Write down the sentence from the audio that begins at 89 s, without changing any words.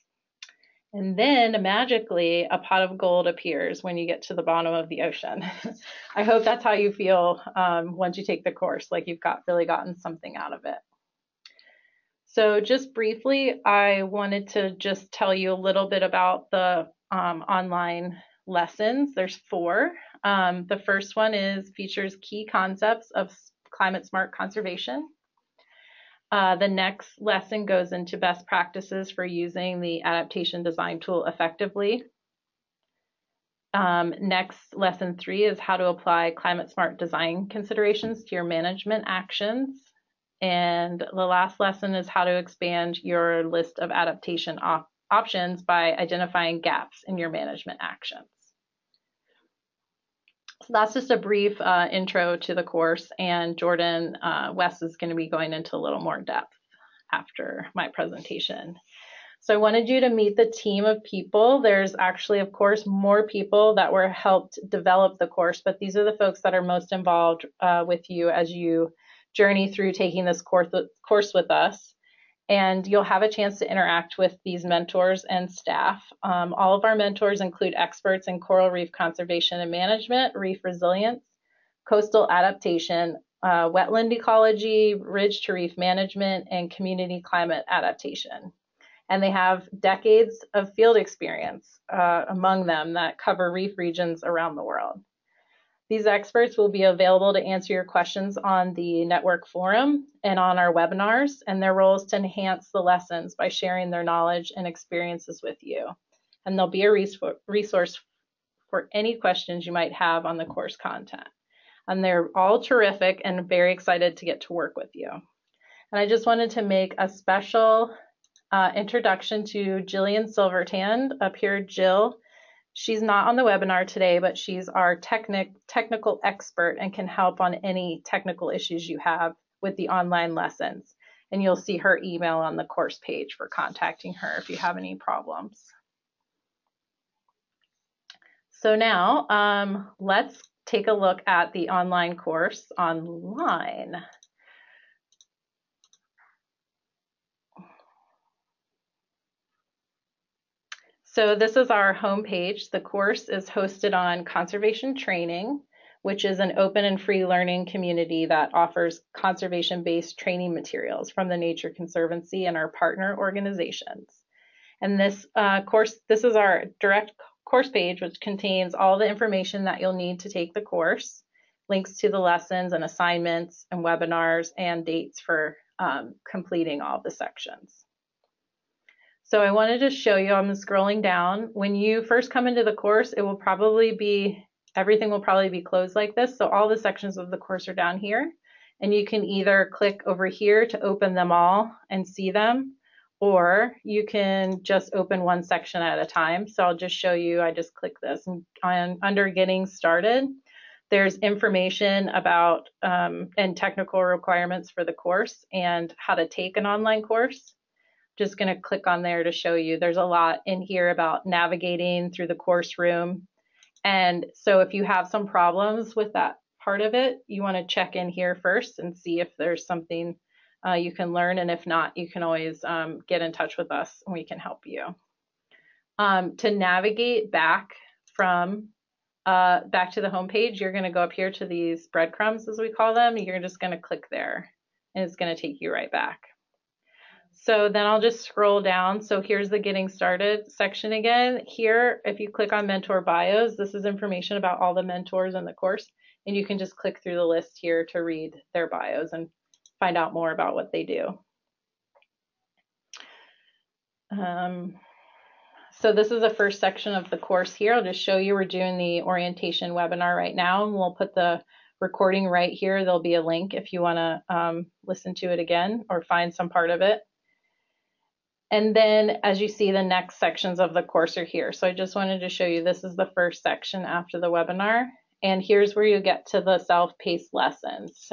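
And they have decades of field experience uh, among them that cover reef regions around the world.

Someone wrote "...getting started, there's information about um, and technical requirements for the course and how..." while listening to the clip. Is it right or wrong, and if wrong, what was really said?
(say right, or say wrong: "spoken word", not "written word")
right.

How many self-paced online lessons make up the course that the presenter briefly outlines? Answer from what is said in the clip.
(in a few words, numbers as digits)
4.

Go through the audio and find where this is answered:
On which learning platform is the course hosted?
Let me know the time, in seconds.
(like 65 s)
154 s.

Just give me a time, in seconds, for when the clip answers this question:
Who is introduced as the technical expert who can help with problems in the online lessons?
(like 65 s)
119 s.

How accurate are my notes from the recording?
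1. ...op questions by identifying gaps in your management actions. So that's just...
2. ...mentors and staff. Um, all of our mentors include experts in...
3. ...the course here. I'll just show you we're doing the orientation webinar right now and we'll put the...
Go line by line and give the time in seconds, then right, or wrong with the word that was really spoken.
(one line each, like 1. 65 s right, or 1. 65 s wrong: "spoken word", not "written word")
1. 44 s wrong: "options", not "questions"
2. 74 s right
3. 257 s right.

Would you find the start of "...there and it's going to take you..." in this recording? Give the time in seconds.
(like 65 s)
234 s.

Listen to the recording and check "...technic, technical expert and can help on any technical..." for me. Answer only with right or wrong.
right.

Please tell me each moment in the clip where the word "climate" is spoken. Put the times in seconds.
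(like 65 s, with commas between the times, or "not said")
23 s, 36 s, 87 s.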